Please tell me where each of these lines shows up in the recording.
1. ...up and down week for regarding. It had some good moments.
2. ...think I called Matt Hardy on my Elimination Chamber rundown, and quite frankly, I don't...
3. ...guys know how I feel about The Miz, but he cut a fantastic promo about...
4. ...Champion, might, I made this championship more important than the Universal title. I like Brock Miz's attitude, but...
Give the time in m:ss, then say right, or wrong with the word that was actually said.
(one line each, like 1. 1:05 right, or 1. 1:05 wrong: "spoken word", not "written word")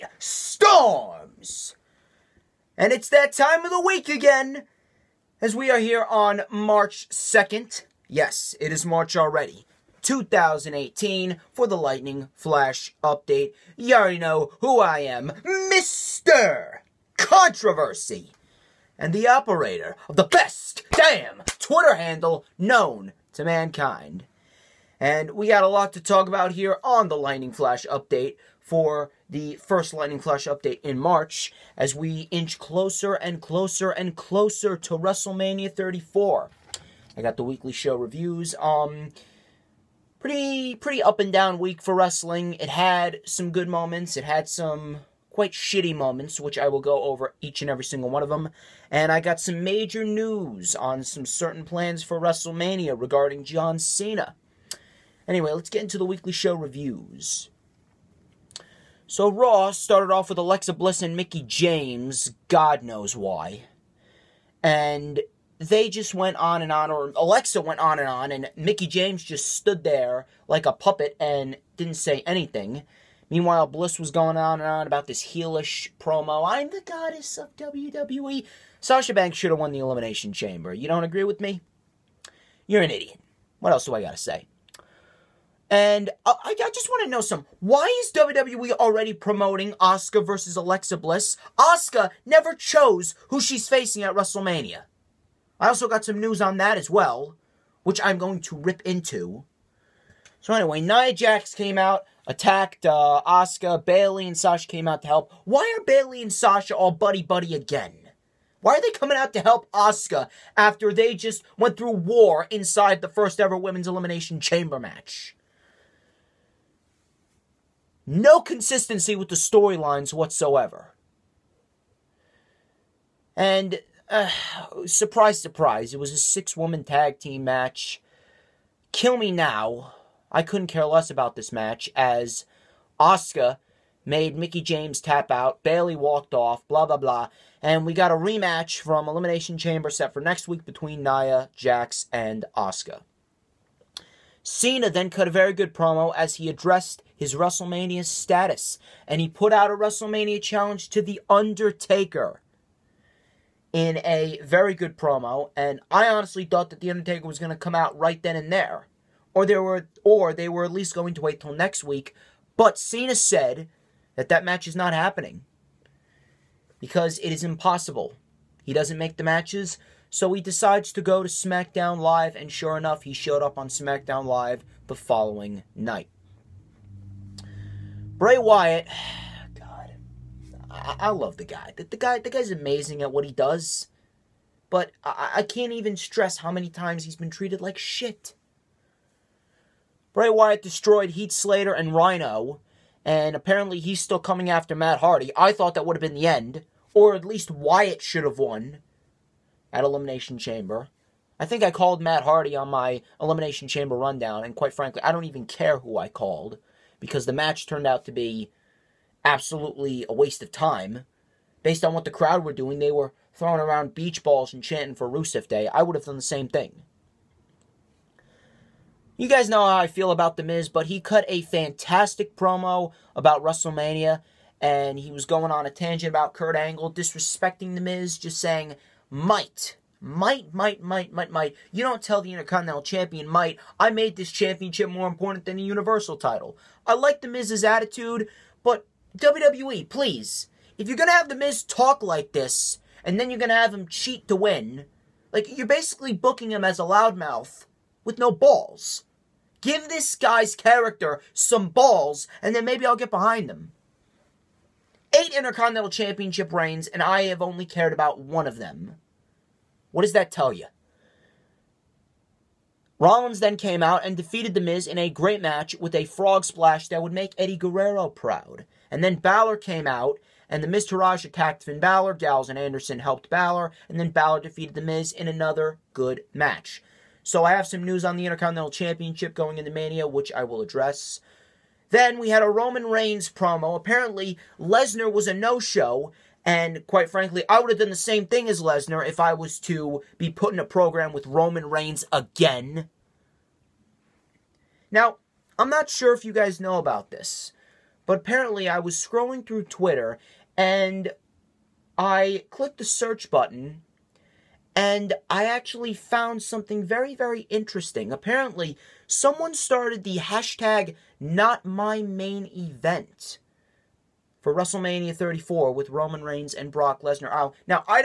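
1. 0:41 wrong: "wrestling", not "regarding"
2. 3:21 right
3. 3:39 right
4. 3:52 wrong: "The", not "Brock".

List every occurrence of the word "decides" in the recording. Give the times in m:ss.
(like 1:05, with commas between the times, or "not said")
2:50.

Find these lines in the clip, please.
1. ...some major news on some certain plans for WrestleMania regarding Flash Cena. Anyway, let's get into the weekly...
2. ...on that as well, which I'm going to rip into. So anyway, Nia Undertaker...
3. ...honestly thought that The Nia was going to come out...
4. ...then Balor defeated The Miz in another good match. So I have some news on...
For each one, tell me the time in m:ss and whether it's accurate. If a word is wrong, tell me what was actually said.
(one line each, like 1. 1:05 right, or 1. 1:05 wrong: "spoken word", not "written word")
1. 0:49 wrong: "John", not "Flash"
2. 1:36 wrong: "Jax", not "Undertaker"
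3. 2:36 wrong: "Undertaker", not "Nia"
4. 4:33 right.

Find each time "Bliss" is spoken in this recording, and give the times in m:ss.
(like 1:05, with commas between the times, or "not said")
1:00, 1:13, 1:30.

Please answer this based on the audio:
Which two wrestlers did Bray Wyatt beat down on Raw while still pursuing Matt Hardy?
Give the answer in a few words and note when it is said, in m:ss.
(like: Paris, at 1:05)
Heath Slater and Rhino, at 3:11.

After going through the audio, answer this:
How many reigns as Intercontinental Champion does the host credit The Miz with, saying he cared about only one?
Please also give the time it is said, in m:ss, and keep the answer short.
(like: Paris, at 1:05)
8, at 4:15.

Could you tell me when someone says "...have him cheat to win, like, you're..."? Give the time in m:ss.
4:03.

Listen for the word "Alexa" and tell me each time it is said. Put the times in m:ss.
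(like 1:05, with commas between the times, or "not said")
1:00, 1:07, 1:30.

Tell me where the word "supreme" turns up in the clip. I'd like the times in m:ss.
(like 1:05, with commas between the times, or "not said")
not said.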